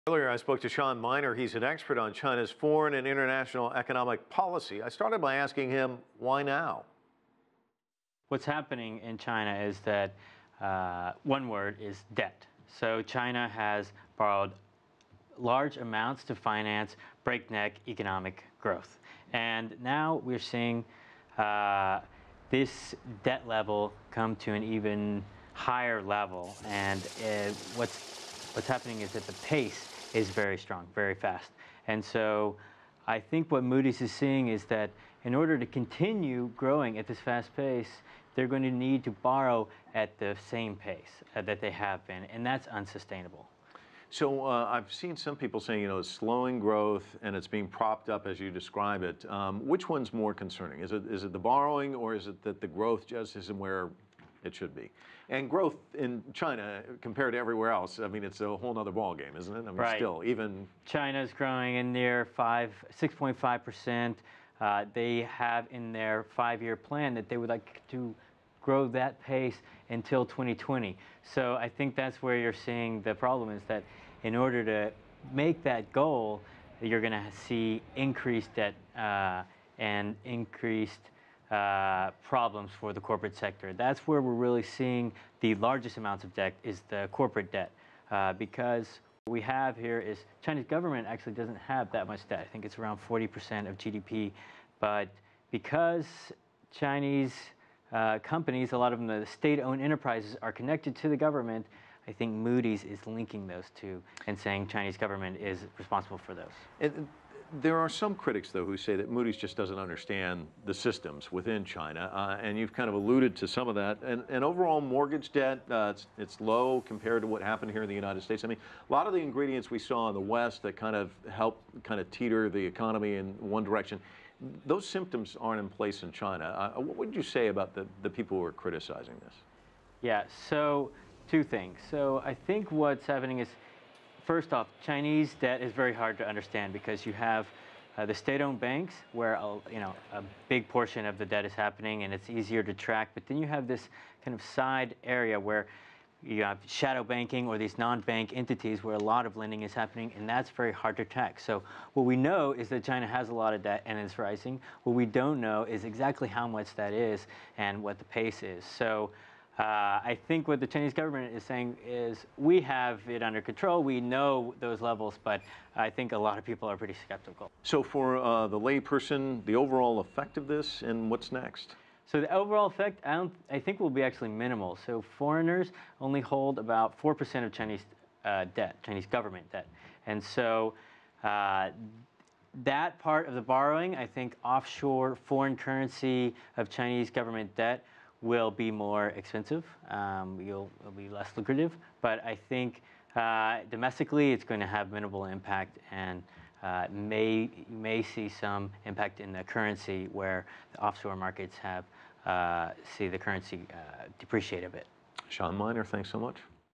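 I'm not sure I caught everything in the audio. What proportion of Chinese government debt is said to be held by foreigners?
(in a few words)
4%.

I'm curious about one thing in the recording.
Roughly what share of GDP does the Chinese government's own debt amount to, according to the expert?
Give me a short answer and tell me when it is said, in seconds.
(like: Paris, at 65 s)
40%, at 93 s.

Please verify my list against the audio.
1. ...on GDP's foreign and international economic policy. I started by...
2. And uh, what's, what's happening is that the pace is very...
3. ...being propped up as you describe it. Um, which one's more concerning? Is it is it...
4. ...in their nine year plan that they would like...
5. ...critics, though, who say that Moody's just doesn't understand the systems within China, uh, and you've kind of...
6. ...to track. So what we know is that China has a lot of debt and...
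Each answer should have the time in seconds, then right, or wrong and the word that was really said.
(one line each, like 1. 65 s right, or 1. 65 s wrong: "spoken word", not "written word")
1. 1 s wrong: "China", not "GDP"
2. 26 s right
3. 47 s right
4. 65 s wrong: "five", not "nine"
5. 108 s right
6. 150 s right.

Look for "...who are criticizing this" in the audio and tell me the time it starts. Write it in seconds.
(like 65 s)
128 s.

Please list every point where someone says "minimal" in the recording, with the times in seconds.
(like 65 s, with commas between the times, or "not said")
174 s, 194 s.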